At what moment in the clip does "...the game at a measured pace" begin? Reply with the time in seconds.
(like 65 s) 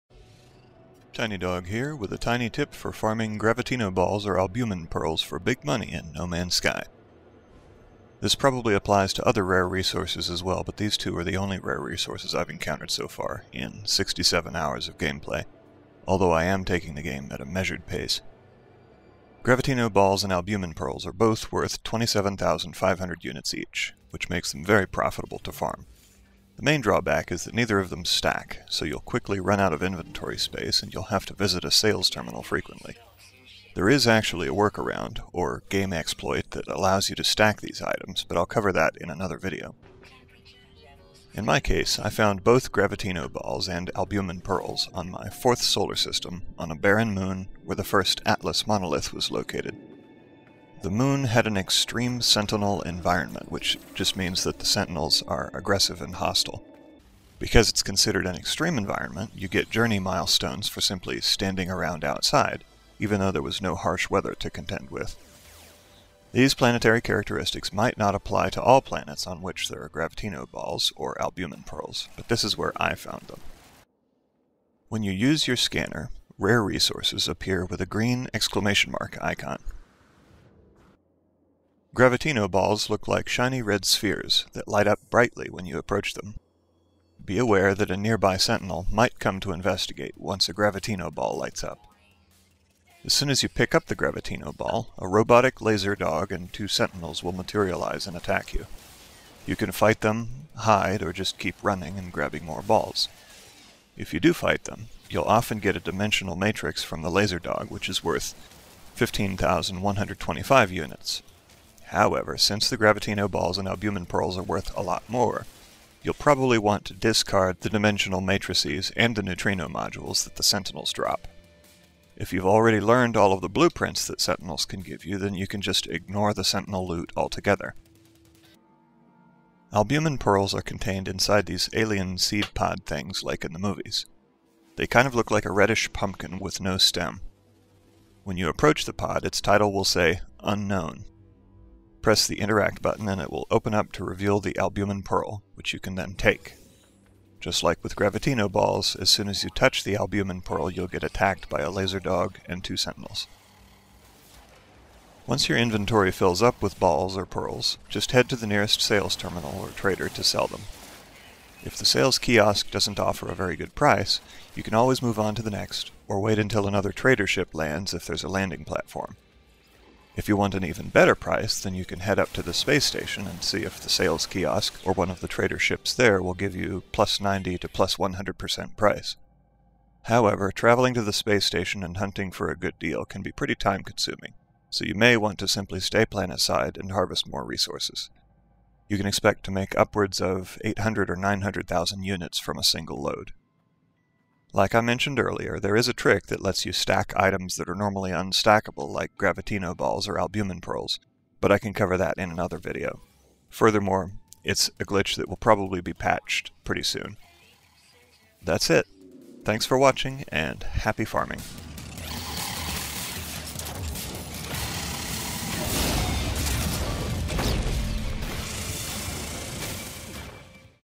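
16 s.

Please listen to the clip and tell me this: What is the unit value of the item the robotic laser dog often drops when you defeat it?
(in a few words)
15,125 units.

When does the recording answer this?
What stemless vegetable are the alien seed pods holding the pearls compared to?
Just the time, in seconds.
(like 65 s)
135 s.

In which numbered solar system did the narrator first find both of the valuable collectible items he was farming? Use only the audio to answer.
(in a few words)
fourth.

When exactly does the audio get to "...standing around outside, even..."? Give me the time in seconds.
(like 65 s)
61 s.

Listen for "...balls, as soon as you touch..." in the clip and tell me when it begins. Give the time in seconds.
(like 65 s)
148 s.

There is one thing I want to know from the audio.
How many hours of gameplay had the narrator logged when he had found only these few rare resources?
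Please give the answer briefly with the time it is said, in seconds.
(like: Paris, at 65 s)
67, at 13 s.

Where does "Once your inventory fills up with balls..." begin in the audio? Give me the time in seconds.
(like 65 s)
155 s.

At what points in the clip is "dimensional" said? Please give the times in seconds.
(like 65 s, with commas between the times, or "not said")
105 s, 117 s.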